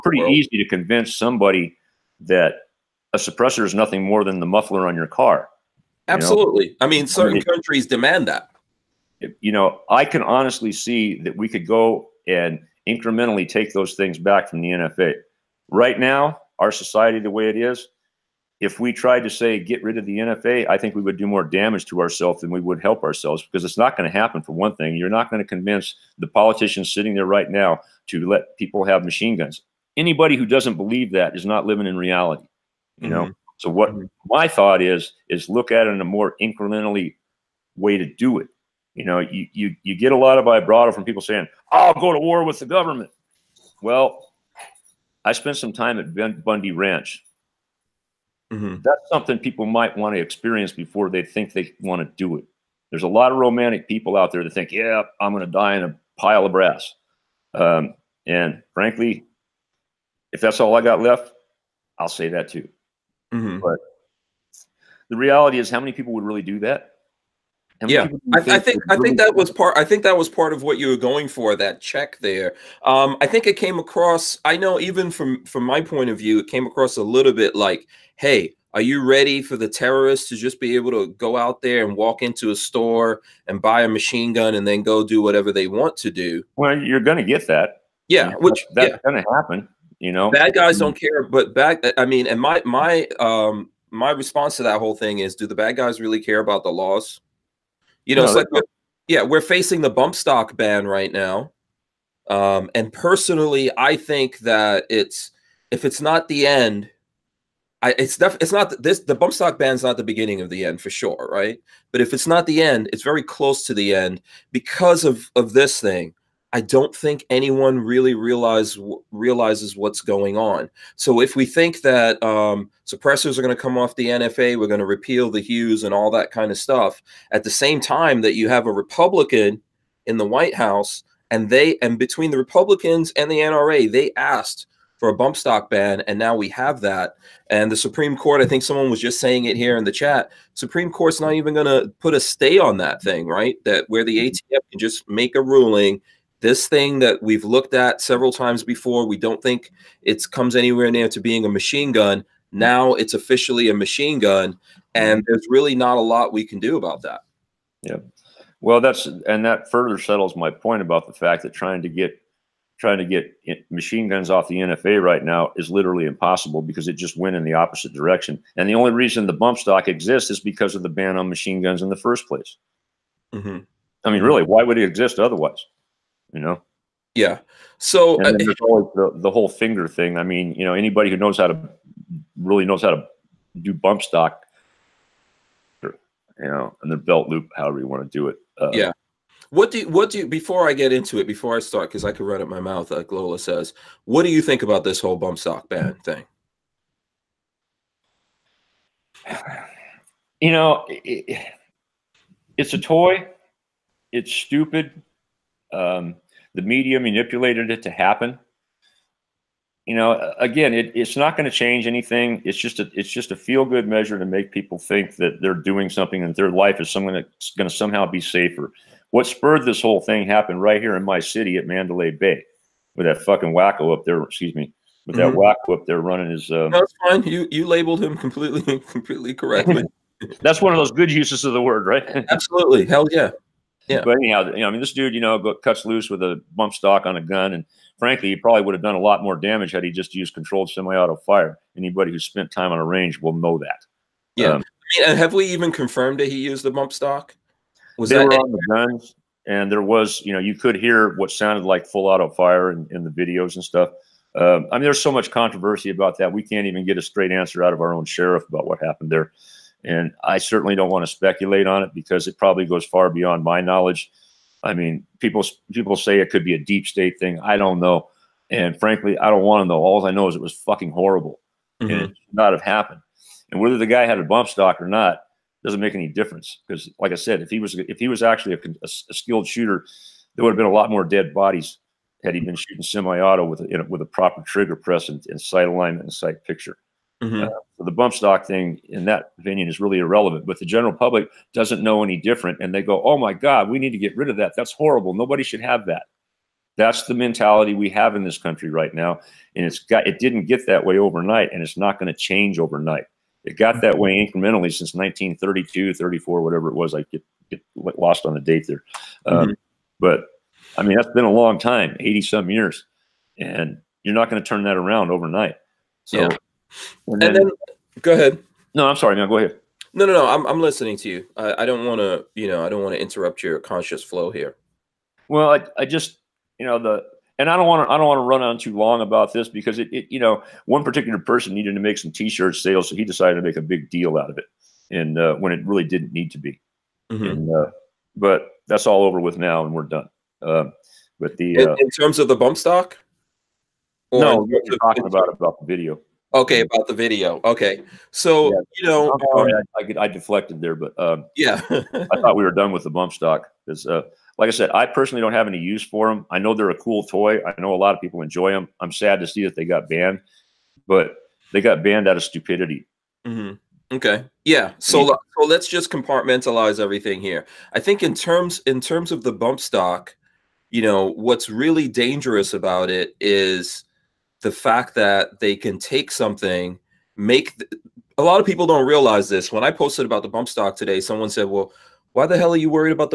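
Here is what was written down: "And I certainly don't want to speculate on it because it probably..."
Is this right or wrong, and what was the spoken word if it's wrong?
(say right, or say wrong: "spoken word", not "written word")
right.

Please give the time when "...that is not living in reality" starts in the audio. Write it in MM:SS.
00:31.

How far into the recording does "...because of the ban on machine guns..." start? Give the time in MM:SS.
02:50.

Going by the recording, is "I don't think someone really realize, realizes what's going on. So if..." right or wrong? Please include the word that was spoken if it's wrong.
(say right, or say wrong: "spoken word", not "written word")
wrong: "anyone", not "someone".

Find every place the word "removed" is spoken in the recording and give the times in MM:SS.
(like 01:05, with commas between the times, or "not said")
not said.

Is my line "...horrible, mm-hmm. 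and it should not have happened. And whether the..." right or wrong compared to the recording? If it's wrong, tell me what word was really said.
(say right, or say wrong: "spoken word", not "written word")
right.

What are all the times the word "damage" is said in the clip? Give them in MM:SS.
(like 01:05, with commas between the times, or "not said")
00:21, 03:59.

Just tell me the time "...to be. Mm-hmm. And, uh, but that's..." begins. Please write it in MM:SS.
05:36.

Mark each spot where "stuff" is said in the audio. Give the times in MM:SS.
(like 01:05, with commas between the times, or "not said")
02:06, 04:13.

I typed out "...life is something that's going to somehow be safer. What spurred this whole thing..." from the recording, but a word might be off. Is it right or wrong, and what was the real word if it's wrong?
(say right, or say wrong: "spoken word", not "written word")
right.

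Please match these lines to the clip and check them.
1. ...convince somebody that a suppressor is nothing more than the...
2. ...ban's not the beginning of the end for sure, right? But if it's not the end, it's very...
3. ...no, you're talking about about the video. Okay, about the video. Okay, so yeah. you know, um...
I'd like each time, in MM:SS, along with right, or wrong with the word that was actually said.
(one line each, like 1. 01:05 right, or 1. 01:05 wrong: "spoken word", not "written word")
1. 00:00 right
2. 01:49 right
3. 05:44 right.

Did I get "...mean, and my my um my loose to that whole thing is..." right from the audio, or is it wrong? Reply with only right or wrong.
wrong.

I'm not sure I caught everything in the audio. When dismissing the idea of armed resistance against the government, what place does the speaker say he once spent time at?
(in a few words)
Bundy Ranch.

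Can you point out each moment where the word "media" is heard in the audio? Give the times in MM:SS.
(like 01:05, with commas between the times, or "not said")
03:26.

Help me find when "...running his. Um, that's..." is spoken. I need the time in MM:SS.
03:46.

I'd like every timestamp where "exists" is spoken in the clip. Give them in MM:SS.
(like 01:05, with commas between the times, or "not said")
02:49, 02:54.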